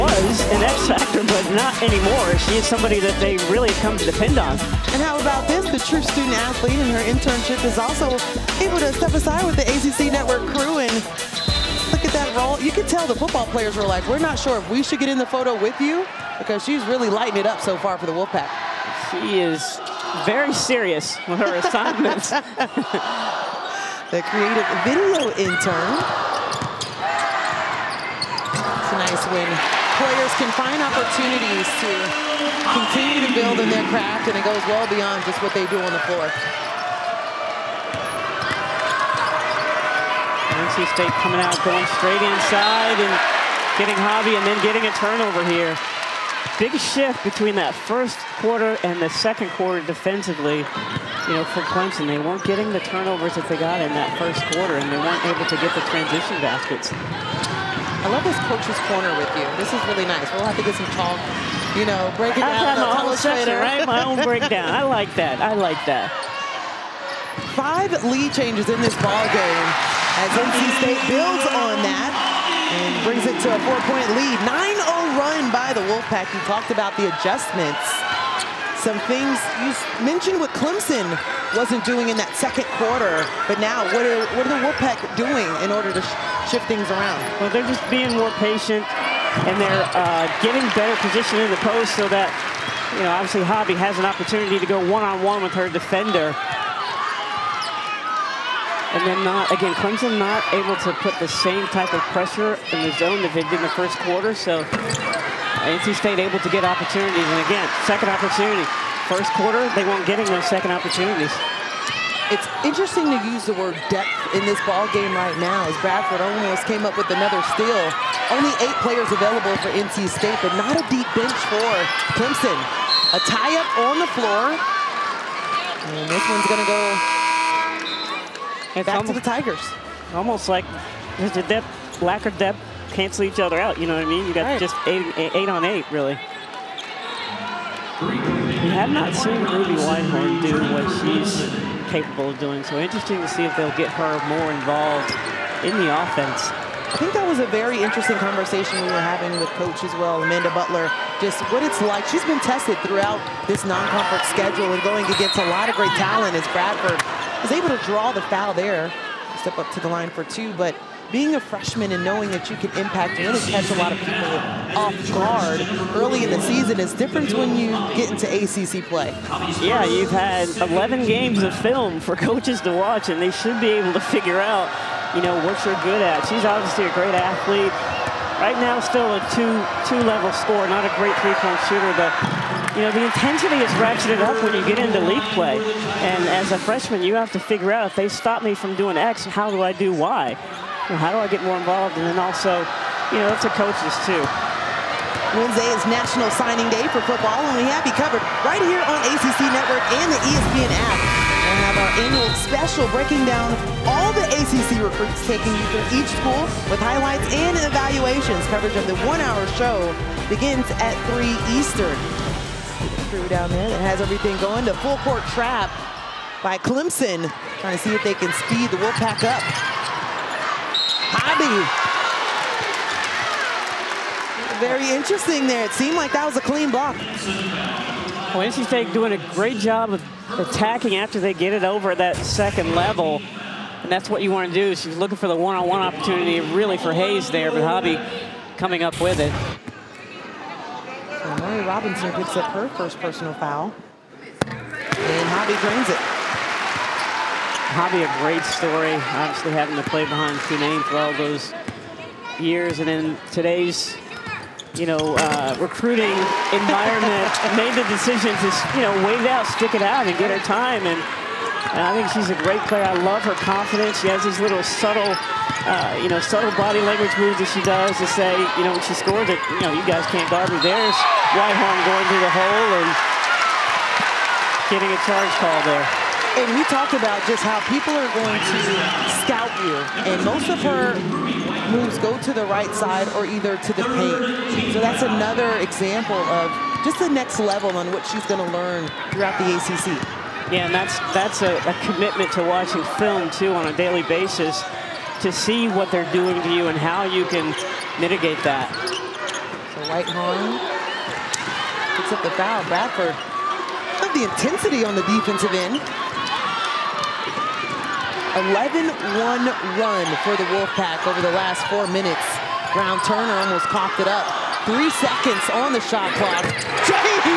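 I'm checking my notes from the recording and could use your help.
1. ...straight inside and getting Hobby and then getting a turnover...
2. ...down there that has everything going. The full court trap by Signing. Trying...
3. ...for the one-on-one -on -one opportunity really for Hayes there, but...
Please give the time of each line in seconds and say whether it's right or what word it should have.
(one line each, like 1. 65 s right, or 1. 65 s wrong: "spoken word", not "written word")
1. 41 s right
2. 213 s wrong: "Clemson", not "Signing"
3. 235 s right.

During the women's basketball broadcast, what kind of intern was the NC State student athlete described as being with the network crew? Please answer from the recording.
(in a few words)
creative video intern.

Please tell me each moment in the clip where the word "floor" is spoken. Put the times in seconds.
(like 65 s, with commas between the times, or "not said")
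36 s, 124 s.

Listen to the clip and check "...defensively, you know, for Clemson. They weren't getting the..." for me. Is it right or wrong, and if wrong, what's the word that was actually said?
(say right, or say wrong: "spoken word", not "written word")
right.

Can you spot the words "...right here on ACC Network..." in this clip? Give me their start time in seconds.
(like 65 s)
198 s.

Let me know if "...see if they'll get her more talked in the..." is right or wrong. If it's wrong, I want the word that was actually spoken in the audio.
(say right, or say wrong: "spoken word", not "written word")
wrong: "involved", not "talked".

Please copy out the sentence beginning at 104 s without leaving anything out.
So NC State able to get opportunities.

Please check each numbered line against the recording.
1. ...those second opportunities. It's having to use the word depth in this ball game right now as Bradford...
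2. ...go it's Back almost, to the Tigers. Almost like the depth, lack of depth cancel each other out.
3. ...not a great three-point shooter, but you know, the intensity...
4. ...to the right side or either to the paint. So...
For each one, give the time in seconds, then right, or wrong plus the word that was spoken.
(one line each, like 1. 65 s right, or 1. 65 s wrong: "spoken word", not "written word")
1. 110 s wrong: "interesting", not "having"
2. 126 s right
3. 180 s right
4. 282 s right.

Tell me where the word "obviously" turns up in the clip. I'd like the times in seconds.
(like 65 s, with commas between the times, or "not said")
93 s, 176 s, 249 s.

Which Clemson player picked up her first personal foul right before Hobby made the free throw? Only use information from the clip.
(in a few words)
Murray Robinson.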